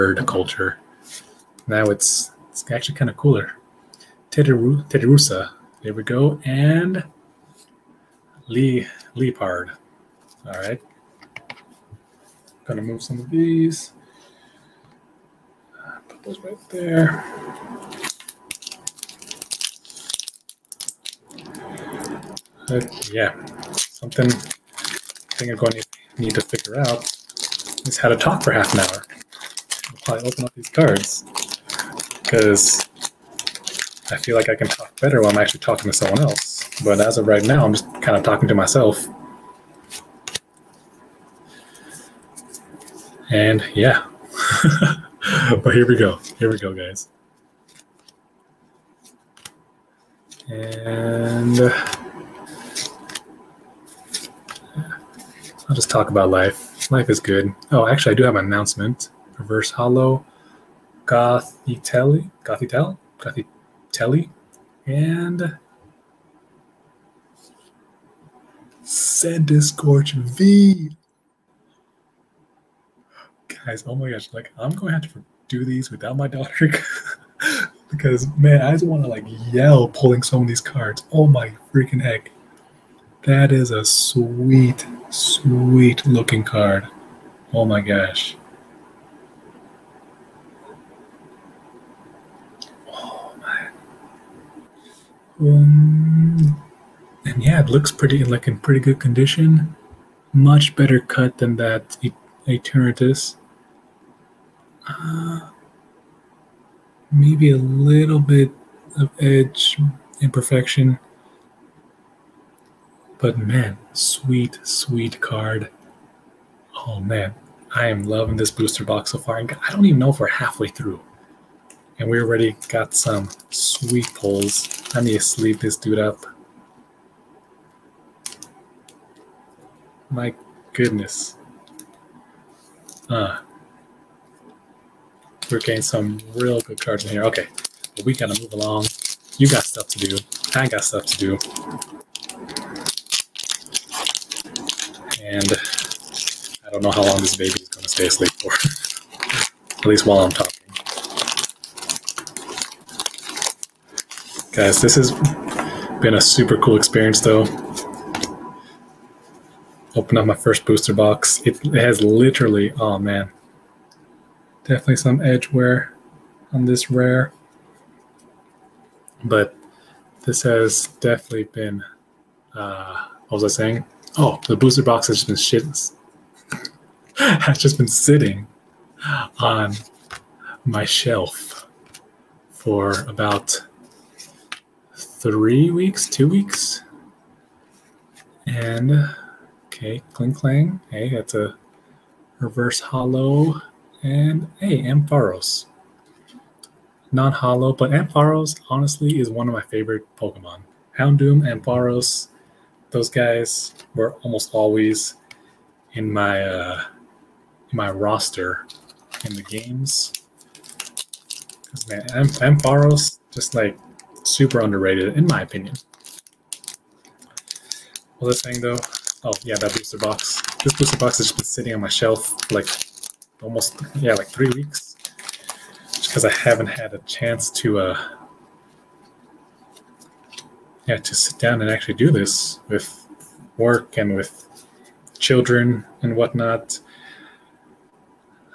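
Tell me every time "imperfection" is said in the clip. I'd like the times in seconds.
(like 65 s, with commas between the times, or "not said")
110 s.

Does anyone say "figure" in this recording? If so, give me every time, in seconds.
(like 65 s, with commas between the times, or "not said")
26 s.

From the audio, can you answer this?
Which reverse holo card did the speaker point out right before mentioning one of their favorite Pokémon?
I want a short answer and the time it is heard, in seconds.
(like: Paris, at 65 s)
Klinklang, at 190 s.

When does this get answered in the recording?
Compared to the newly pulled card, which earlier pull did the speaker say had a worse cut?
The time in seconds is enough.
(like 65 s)
102 s.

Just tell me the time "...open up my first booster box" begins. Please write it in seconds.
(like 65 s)
159 s.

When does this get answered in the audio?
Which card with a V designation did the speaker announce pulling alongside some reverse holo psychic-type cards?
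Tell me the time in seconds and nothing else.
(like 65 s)
68 s.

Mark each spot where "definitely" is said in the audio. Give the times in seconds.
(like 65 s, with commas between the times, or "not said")
164 s, 171 s.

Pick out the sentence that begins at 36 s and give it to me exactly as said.
But as of right now, I'm just kind of talking to myself.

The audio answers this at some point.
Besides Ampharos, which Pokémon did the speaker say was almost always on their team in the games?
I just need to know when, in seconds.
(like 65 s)
200 s.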